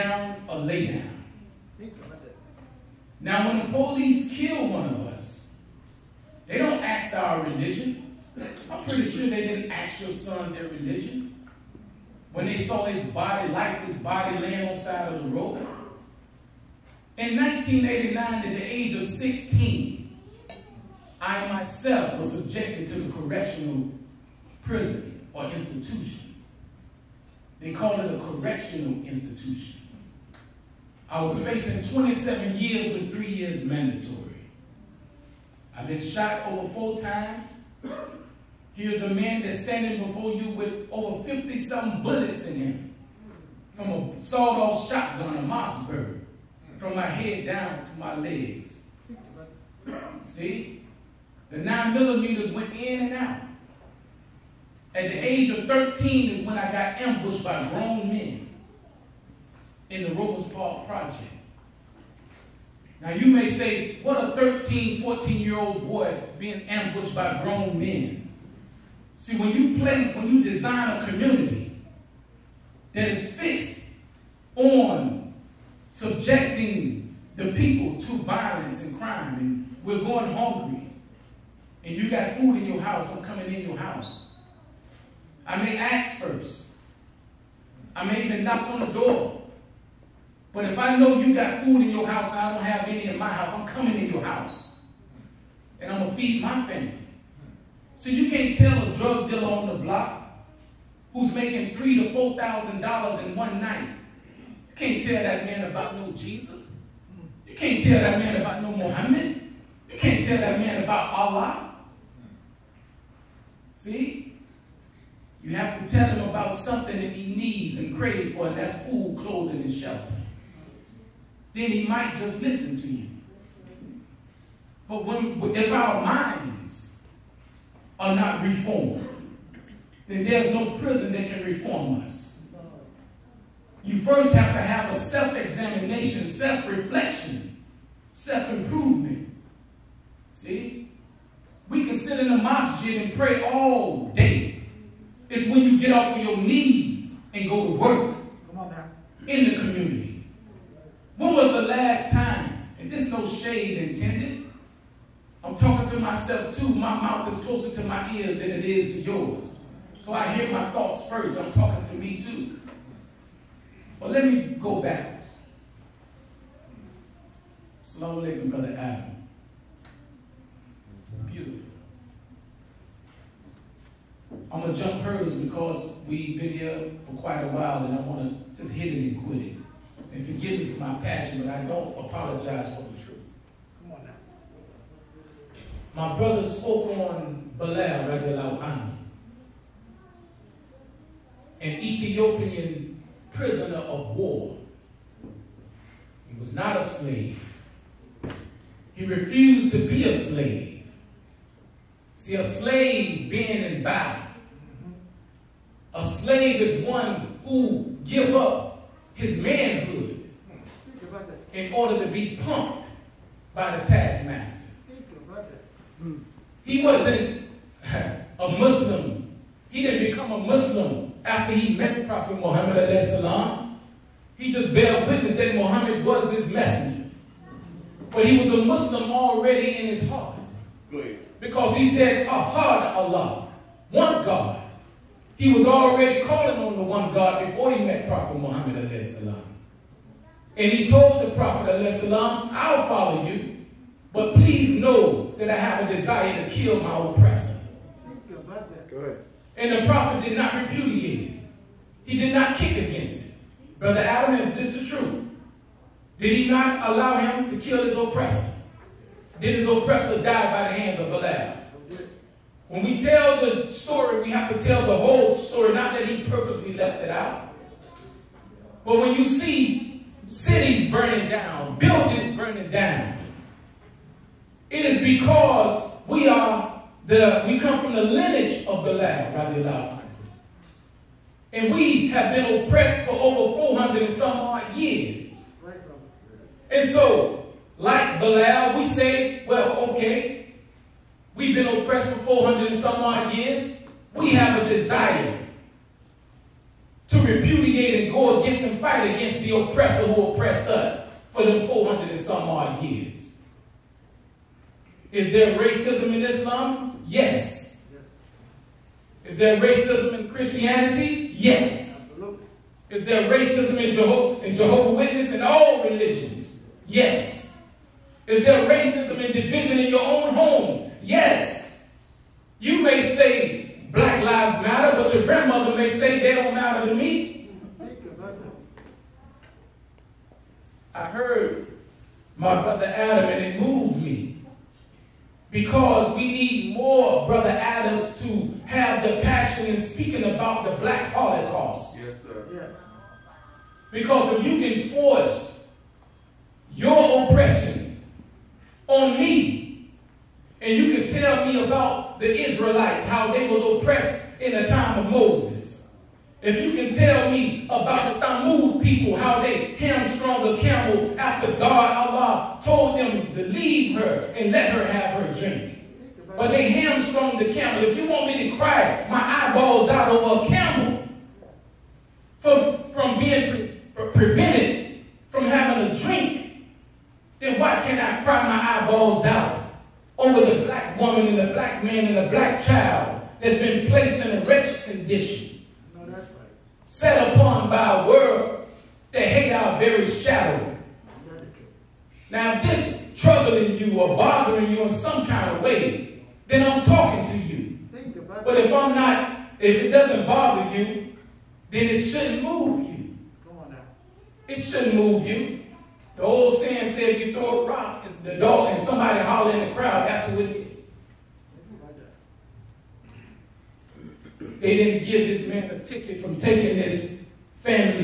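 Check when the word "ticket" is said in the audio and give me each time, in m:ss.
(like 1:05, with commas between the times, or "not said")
6:55.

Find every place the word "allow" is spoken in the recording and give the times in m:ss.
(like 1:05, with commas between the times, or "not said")
4:16.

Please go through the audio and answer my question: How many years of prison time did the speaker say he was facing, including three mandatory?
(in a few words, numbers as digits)
27 years.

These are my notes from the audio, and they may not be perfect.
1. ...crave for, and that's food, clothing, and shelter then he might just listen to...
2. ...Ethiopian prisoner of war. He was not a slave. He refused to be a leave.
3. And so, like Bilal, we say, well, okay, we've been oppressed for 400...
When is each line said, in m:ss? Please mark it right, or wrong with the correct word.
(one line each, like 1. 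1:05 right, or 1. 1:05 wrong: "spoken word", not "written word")
1. 1:57 right
2. 3:11 wrong: "slave", not "leave"
3. 4:46 right.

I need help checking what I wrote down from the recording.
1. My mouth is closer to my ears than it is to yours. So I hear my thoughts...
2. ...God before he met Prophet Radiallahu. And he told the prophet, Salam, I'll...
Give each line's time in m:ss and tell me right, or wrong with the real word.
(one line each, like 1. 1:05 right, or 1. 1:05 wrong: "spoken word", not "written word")
1. 2:36 right
2. 3:57 wrong: "Muhammad", not "Radiallahu".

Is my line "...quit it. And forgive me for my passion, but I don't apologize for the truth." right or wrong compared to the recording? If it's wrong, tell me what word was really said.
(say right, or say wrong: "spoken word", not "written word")
right.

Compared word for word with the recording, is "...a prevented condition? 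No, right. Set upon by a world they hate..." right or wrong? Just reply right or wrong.
wrong.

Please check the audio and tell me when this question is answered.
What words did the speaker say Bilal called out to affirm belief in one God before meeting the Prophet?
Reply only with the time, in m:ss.
3:52.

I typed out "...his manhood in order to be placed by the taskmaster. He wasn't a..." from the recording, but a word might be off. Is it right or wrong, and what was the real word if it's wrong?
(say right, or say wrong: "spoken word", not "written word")
wrong: "pumped", not "placed".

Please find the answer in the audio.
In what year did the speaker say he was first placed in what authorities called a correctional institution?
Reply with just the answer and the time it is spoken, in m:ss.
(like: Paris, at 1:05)
1989, at 0:17.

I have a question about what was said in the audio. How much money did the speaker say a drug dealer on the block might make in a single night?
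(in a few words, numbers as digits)
$3,000 to $4,000.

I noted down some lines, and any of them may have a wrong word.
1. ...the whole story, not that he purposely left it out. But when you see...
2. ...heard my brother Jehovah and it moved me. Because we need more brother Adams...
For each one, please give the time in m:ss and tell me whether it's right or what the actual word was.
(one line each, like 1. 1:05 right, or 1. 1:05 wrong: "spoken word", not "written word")
1. 4:24 right
2. 5:31 wrong: "Adam", not "Jehovah".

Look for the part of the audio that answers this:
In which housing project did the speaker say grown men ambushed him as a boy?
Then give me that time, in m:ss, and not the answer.
1:00.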